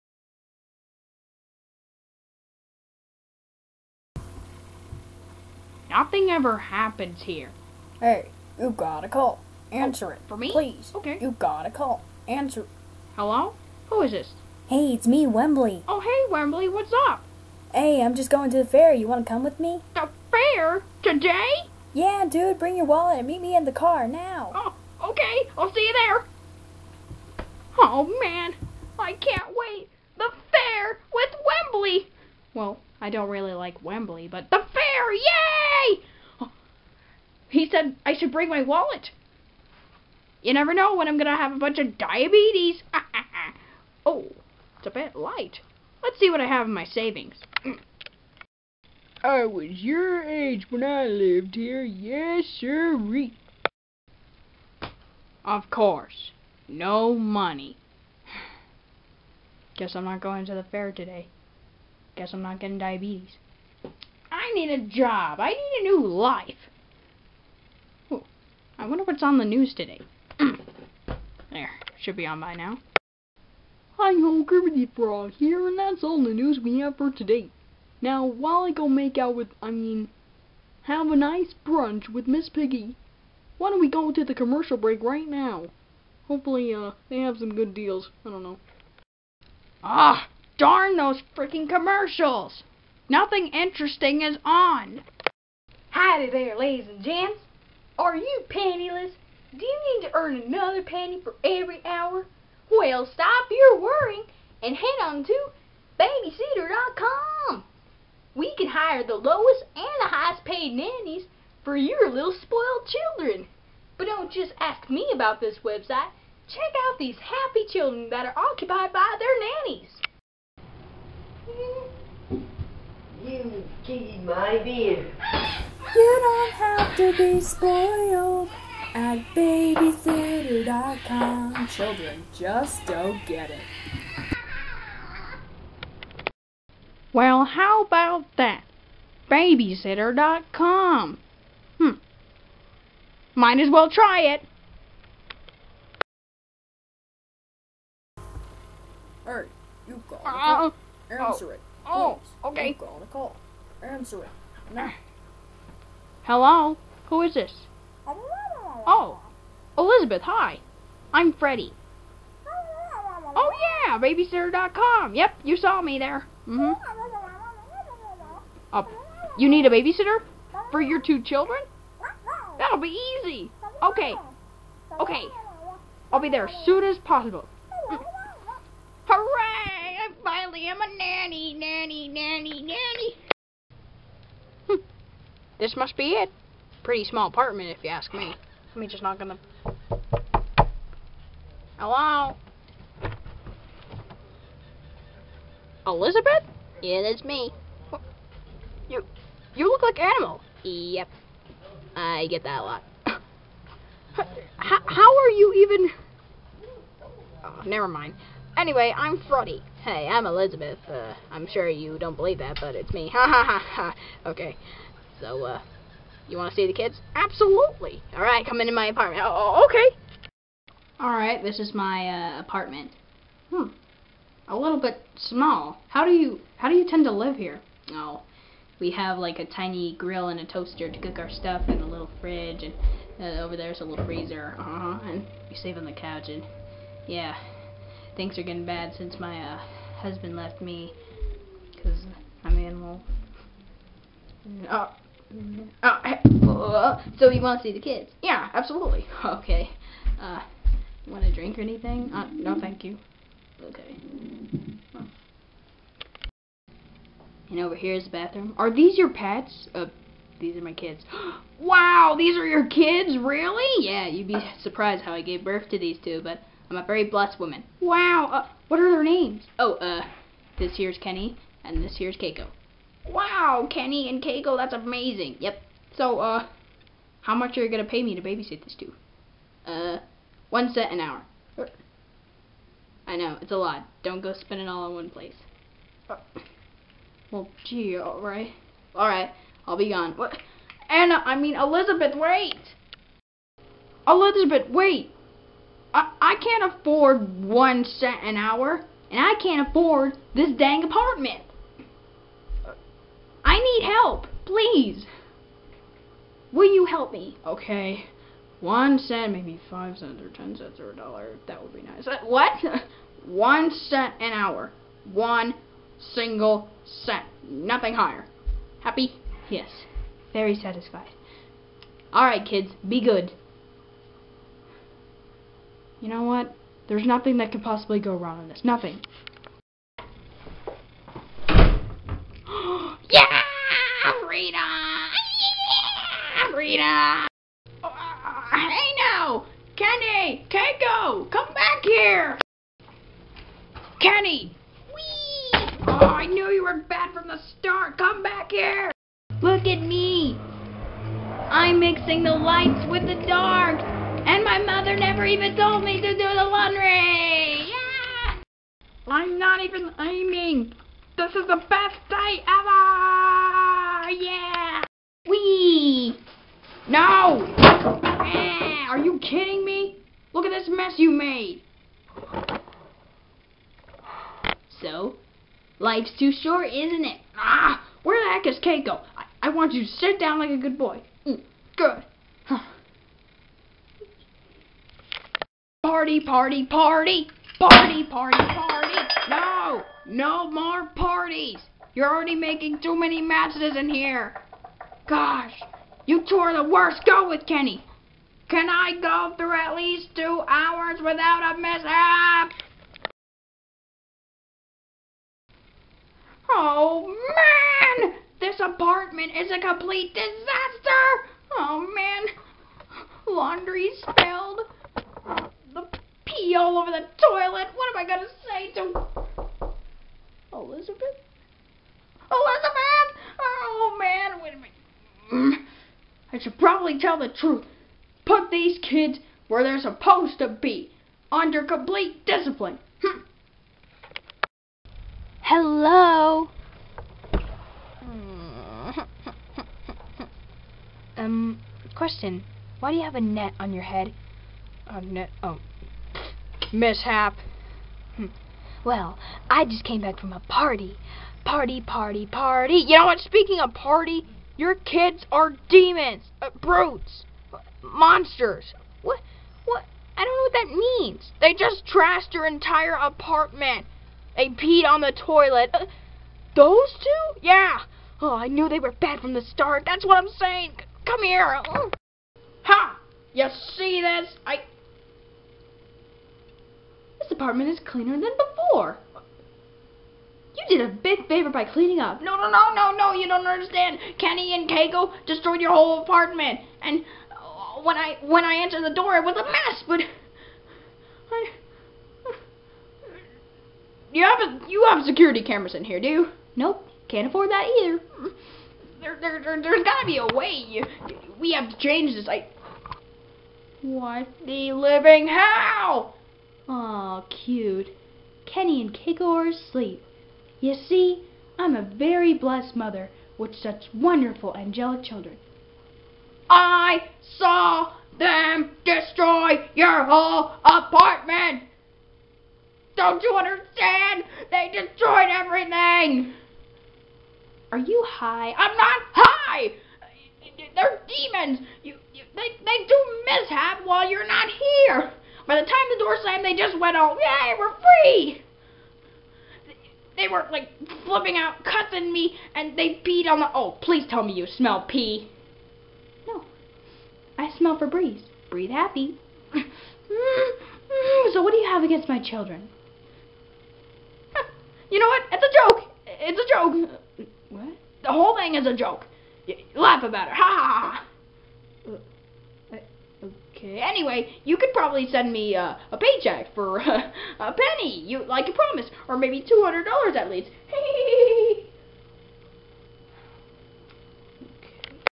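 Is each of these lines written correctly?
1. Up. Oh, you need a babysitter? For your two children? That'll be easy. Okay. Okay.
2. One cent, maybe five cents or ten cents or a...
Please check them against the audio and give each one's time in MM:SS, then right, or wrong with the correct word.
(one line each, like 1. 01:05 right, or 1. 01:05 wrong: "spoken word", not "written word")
1. 02:48 right
2. 05:08 right.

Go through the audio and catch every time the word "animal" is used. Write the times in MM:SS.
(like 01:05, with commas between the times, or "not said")
03:19, 04:02.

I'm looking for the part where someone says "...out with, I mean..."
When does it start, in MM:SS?
01:19.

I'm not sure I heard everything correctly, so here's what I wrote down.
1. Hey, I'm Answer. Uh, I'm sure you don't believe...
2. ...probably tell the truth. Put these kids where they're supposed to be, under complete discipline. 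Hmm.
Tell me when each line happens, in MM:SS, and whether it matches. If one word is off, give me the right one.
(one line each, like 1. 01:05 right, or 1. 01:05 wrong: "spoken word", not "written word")
1. 03:29 wrong: "Elizabeth", not "Answer"
2. 07:06 right.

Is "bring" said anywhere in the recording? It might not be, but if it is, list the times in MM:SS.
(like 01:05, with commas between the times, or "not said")
00:22, 00:38.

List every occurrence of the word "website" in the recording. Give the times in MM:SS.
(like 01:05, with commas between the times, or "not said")
01:55.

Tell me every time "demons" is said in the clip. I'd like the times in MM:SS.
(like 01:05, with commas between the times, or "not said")
07:35, 08:51.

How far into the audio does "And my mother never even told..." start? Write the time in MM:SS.
05:54.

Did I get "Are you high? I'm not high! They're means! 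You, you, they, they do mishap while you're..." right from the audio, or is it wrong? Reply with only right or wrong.
wrong.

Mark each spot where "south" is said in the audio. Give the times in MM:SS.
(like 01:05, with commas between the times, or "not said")
not said.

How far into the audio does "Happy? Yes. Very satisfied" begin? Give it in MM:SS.
05:18.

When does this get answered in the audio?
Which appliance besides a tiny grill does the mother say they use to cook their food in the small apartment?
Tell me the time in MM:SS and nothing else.
03:50.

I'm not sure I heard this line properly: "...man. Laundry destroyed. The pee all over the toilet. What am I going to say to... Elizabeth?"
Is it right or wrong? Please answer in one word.
wrong.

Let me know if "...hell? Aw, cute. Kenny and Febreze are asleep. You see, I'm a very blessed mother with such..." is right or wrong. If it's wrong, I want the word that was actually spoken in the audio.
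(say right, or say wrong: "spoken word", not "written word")
wrong: "Keiko", not "Febreze".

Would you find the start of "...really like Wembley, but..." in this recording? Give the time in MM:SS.
00:33.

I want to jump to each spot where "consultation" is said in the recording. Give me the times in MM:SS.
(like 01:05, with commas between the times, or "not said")
not said.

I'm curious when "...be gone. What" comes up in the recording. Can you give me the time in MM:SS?
04:49.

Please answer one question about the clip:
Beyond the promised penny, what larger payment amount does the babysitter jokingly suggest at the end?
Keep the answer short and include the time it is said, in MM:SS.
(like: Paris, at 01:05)
$200, at 09:29.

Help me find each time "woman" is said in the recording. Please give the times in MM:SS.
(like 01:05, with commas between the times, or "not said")
04:27.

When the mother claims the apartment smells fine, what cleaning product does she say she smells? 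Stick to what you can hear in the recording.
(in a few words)
Febreze.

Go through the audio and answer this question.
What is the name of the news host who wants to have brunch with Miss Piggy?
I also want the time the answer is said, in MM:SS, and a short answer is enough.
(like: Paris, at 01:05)
Gravity Frog, at 01:14.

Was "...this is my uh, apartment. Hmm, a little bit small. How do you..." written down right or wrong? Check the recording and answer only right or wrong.
right.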